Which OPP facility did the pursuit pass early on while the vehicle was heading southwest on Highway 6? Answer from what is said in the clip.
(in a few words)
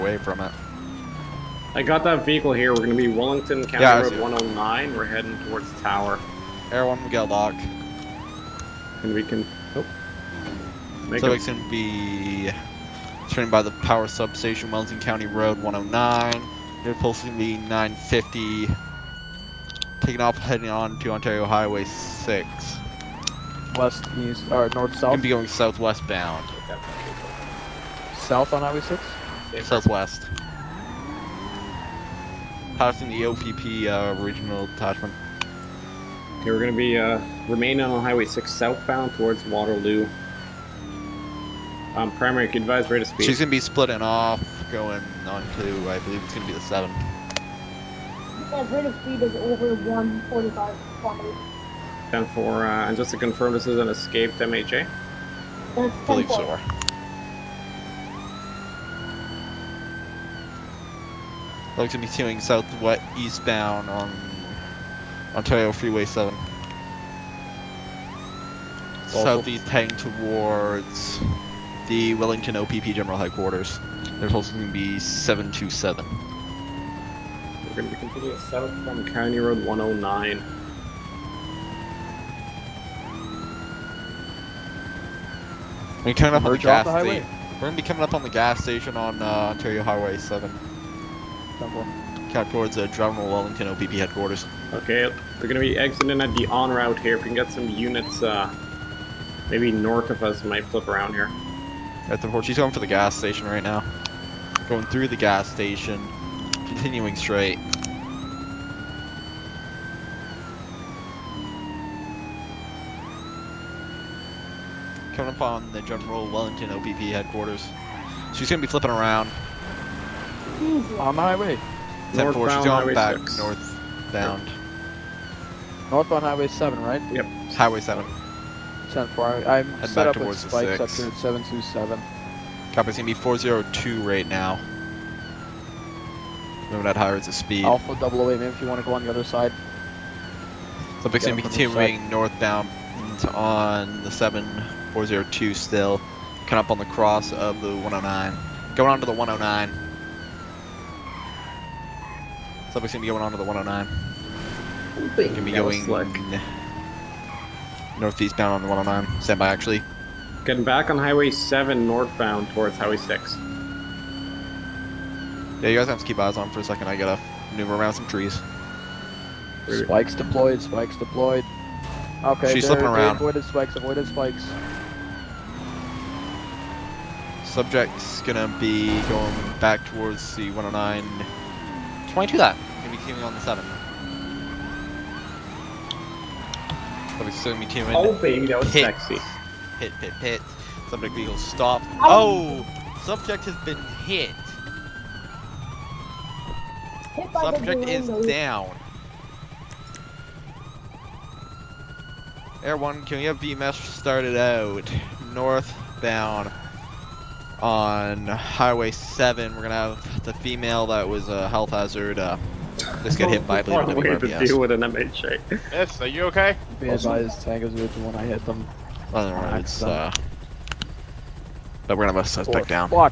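Regional detachment.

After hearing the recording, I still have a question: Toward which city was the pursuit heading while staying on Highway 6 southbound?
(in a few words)
Waterloo.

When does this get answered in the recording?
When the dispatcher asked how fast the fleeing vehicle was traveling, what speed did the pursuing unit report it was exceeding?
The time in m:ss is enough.
0:49.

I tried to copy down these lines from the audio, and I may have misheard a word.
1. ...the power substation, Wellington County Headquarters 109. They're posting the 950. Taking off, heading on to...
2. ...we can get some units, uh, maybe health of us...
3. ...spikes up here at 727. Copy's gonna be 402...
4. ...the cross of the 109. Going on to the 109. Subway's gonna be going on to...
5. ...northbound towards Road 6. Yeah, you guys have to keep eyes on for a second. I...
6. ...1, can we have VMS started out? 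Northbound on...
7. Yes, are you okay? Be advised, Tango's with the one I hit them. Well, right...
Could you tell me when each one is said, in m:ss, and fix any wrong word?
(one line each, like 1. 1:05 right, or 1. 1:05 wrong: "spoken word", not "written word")
1. 0:13 wrong: "Road", not "Headquarters"
2. 1:37 wrong: "north", not "health"
3. 2:10 right
4. 2:26 right
5. 2:41 wrong: "Highway", not "Road"
6. 3:22 right
7. 3:35 right.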